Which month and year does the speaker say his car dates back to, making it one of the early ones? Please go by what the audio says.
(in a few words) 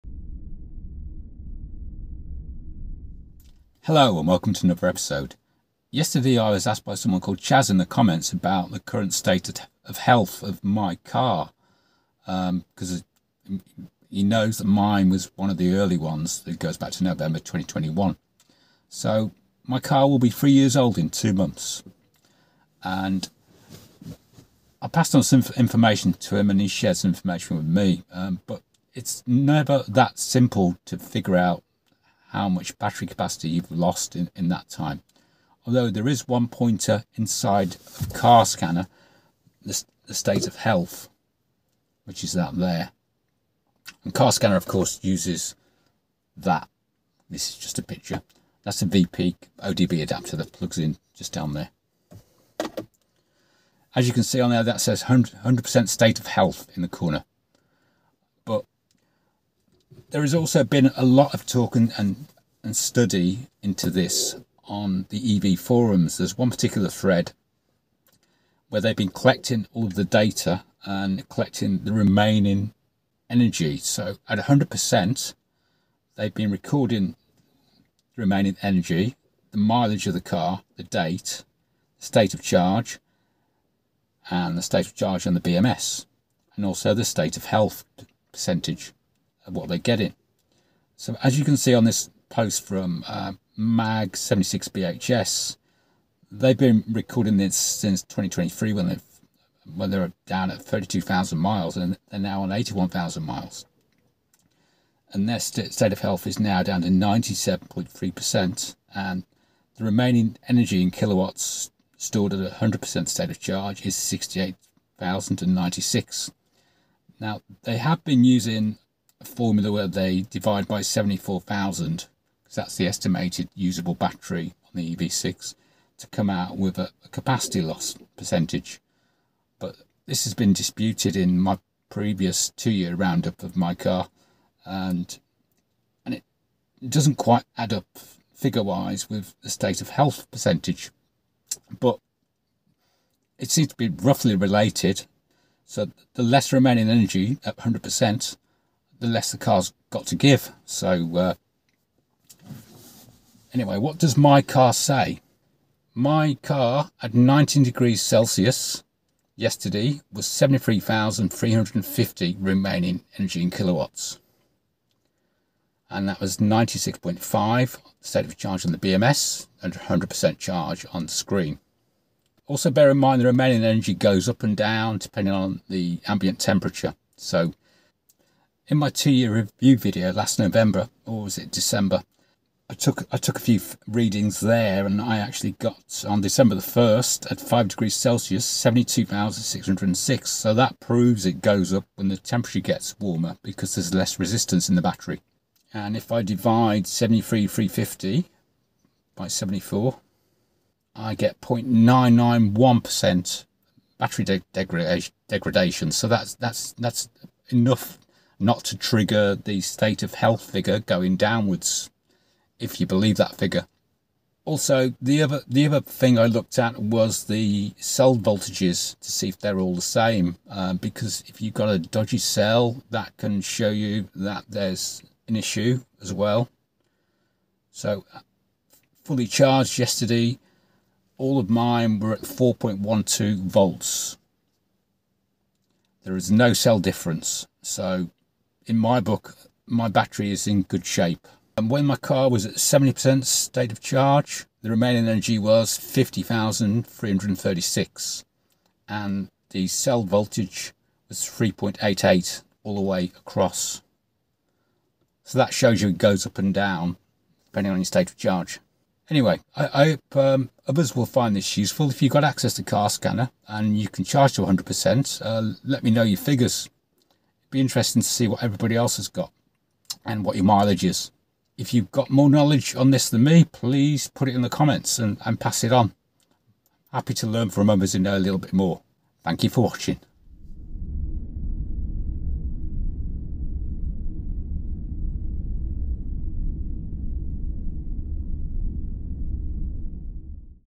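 November 2021.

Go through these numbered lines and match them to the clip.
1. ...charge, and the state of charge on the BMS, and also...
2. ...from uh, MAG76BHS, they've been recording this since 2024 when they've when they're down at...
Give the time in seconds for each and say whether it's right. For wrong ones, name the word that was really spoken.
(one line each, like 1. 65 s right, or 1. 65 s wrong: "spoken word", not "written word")
1. 82 s right
2. 92 s wrong: "2023", not "2024".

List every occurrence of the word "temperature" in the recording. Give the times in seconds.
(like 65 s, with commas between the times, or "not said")
176 s, 192 s.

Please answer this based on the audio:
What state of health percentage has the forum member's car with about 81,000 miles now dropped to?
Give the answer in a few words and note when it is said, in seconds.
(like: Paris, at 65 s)
97.3%, at 106 s.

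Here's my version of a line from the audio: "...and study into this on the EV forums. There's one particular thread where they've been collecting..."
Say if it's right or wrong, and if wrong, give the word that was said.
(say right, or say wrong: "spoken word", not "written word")
right.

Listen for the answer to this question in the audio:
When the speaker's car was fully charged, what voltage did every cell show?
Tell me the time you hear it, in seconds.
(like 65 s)
232 s.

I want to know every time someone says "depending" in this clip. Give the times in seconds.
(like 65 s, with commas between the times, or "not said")
174 s, 257 s.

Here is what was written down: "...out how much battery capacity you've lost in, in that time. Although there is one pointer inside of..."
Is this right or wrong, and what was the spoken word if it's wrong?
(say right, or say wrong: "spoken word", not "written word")
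right.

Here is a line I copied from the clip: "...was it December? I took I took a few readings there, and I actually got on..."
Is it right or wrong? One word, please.
right.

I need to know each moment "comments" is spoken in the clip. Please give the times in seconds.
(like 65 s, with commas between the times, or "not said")
7 s, 274 s.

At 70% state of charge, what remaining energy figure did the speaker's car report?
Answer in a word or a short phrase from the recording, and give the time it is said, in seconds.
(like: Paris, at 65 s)
50,336, at 245 s.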